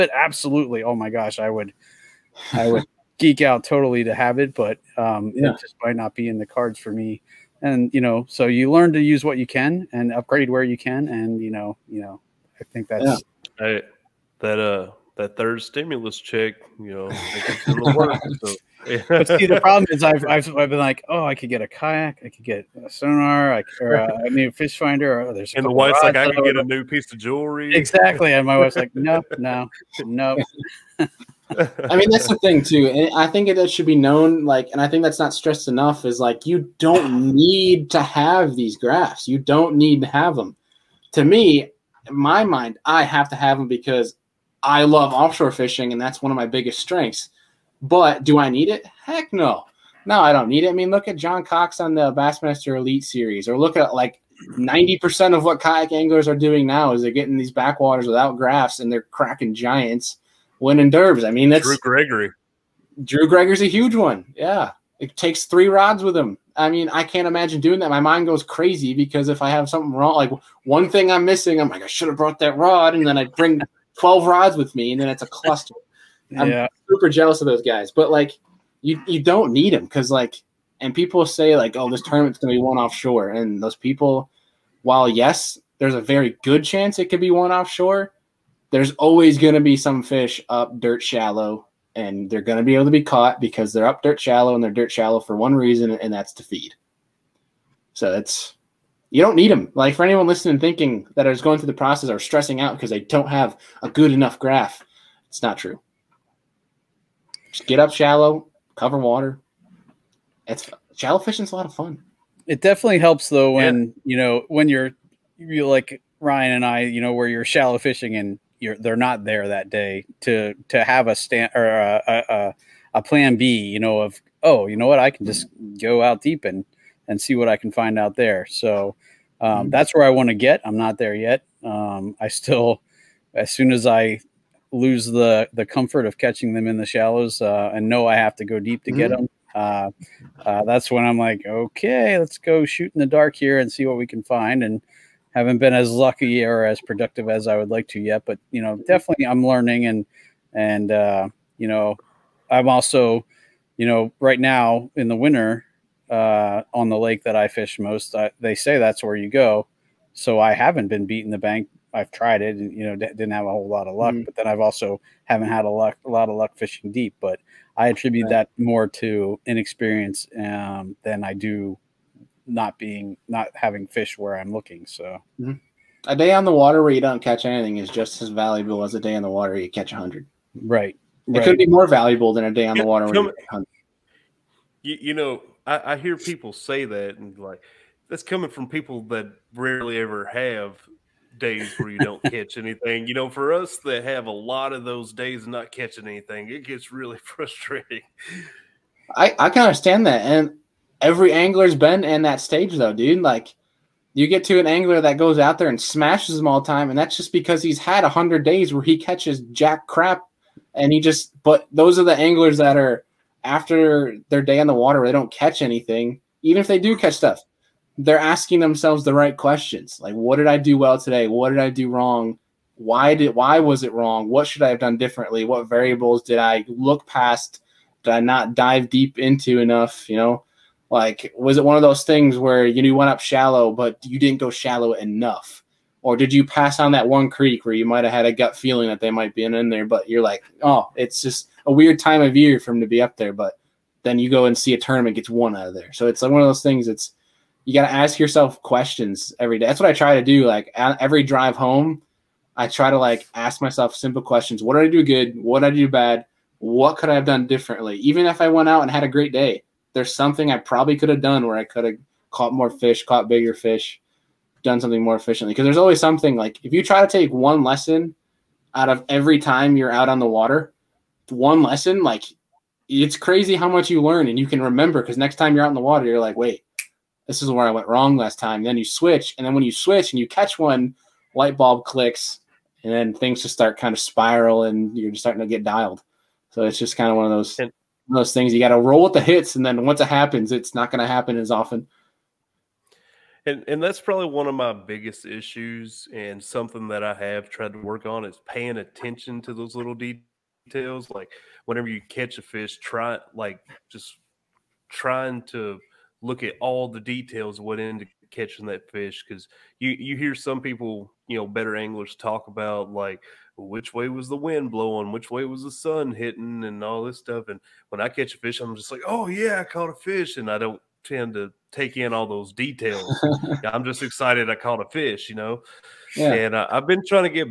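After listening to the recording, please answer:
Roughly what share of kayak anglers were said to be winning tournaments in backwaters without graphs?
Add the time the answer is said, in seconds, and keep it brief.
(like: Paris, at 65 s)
90%, at 54 s.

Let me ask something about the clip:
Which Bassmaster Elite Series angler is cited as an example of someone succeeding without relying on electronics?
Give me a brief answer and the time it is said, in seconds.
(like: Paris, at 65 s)
John Cox, at 51 s.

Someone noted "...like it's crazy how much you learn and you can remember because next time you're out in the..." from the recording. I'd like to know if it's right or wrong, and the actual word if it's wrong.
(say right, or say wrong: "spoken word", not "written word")
right.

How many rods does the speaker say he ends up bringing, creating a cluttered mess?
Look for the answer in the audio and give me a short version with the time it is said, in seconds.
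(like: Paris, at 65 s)
12, at 73 s.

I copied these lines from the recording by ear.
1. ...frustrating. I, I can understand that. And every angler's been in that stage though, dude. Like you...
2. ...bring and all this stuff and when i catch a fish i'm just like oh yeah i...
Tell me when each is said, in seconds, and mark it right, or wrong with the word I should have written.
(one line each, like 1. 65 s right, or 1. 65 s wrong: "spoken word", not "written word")
1. 197 s right
2. 316 s wrong: "hitting", not "bring".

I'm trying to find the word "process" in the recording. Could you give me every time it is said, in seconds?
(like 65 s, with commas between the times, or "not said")
101 s.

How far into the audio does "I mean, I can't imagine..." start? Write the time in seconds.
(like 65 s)
66 s.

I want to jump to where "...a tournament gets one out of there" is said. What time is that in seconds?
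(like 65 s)
244 s.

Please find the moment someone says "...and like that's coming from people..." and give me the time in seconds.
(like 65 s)
187 s.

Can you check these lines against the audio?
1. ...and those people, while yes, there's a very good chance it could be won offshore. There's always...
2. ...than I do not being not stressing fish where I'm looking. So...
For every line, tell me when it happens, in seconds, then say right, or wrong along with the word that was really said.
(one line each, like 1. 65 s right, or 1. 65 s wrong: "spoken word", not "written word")
1. 83 s right
2. 171 s wrong: "having", not "stressing".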